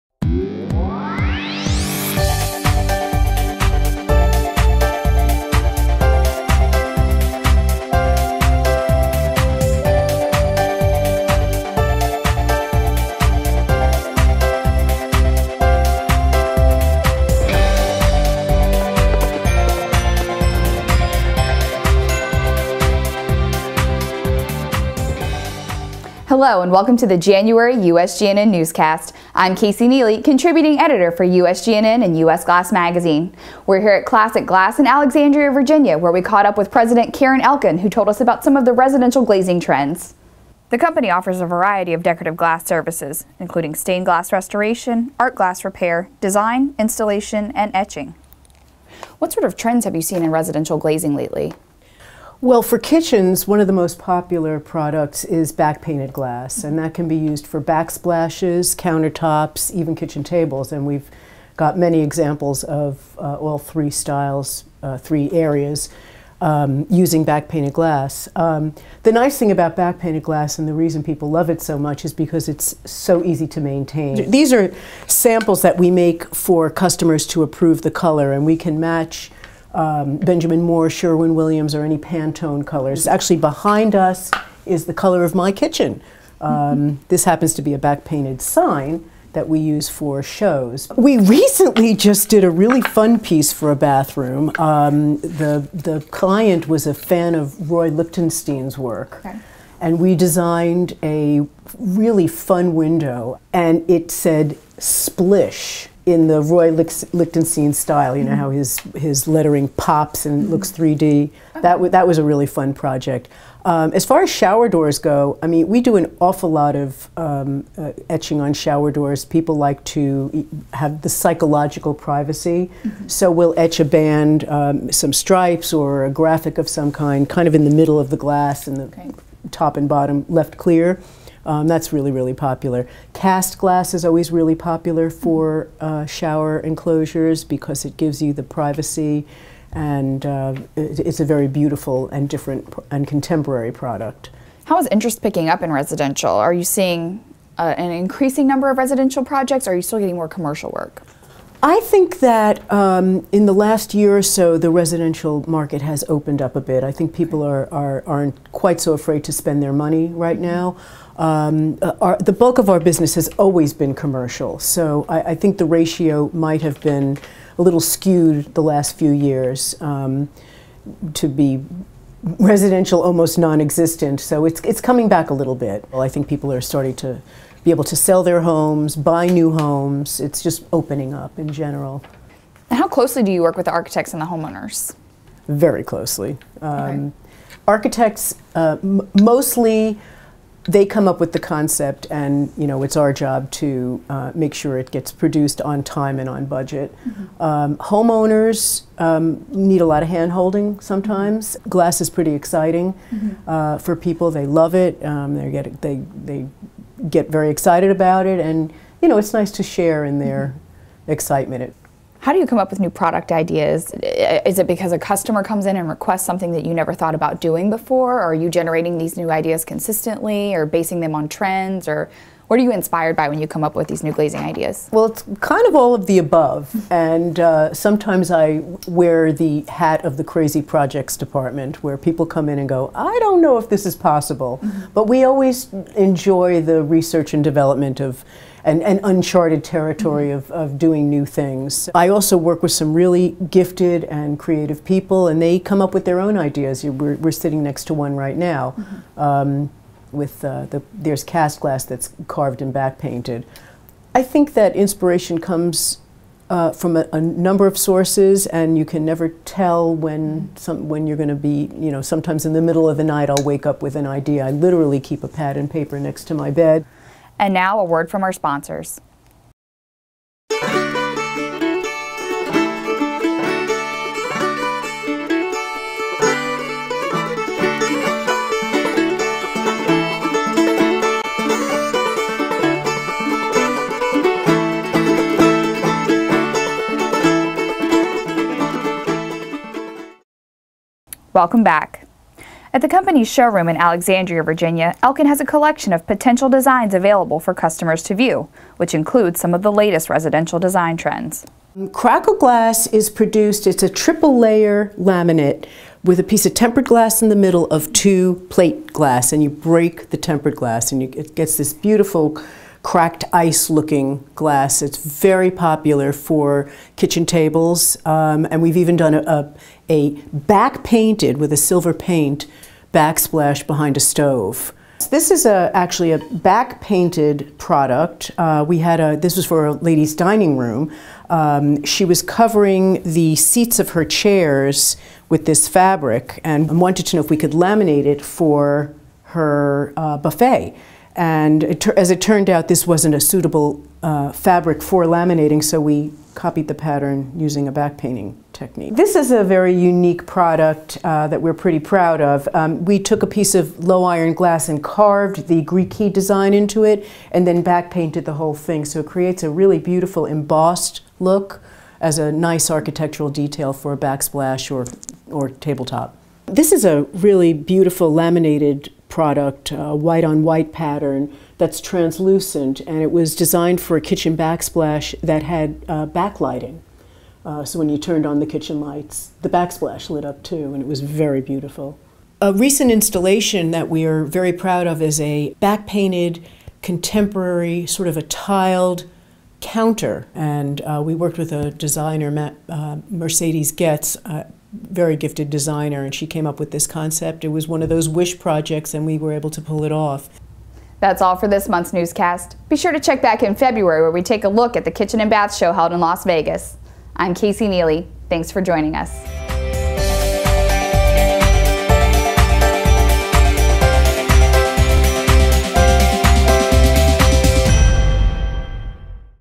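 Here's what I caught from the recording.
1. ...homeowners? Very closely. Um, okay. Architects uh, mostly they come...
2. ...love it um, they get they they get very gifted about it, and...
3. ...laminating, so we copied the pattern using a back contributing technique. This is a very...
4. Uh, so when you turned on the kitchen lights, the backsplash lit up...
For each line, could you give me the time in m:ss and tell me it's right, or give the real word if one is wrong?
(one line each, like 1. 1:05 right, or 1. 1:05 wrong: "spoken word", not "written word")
1. 3:04 right
2. 3:24 wrong: "excited", not "gifted"
3. 5:45 wrong: "painting", not "contributing"
4. 6:17 right.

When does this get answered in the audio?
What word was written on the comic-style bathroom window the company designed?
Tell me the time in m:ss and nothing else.
1:44.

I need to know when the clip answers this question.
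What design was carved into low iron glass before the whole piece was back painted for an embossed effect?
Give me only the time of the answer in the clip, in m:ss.
5:55.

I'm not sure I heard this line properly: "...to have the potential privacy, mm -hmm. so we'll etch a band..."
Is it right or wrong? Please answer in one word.
wrong.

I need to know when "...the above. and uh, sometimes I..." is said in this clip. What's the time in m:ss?
3:46.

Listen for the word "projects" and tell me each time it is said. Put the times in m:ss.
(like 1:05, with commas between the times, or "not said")
1:52, 2:29, 3:50, 6:38.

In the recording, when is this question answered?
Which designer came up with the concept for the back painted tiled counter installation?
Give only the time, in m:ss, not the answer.
6:33.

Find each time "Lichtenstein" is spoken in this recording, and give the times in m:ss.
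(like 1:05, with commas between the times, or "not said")
1:37, 1:46.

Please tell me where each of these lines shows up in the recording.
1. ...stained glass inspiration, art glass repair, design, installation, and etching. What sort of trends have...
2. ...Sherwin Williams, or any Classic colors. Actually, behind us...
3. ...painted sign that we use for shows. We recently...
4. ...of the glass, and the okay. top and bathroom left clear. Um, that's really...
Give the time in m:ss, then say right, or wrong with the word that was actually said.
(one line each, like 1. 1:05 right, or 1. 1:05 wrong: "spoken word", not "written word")
1. 0:43 wrong: "restoration", not "inspiration"
2. 1:20 wrong: "Pantone", not "Classic"
3. 1:28 right
4. 2:07 wrong: "bottom", not "bathroom".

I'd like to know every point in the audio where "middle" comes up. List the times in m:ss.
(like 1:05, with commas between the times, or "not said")
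2:07, 4:22, 5:07.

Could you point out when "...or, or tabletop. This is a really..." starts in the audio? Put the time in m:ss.
6:04.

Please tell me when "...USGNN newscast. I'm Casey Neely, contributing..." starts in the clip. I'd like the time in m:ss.
0:27.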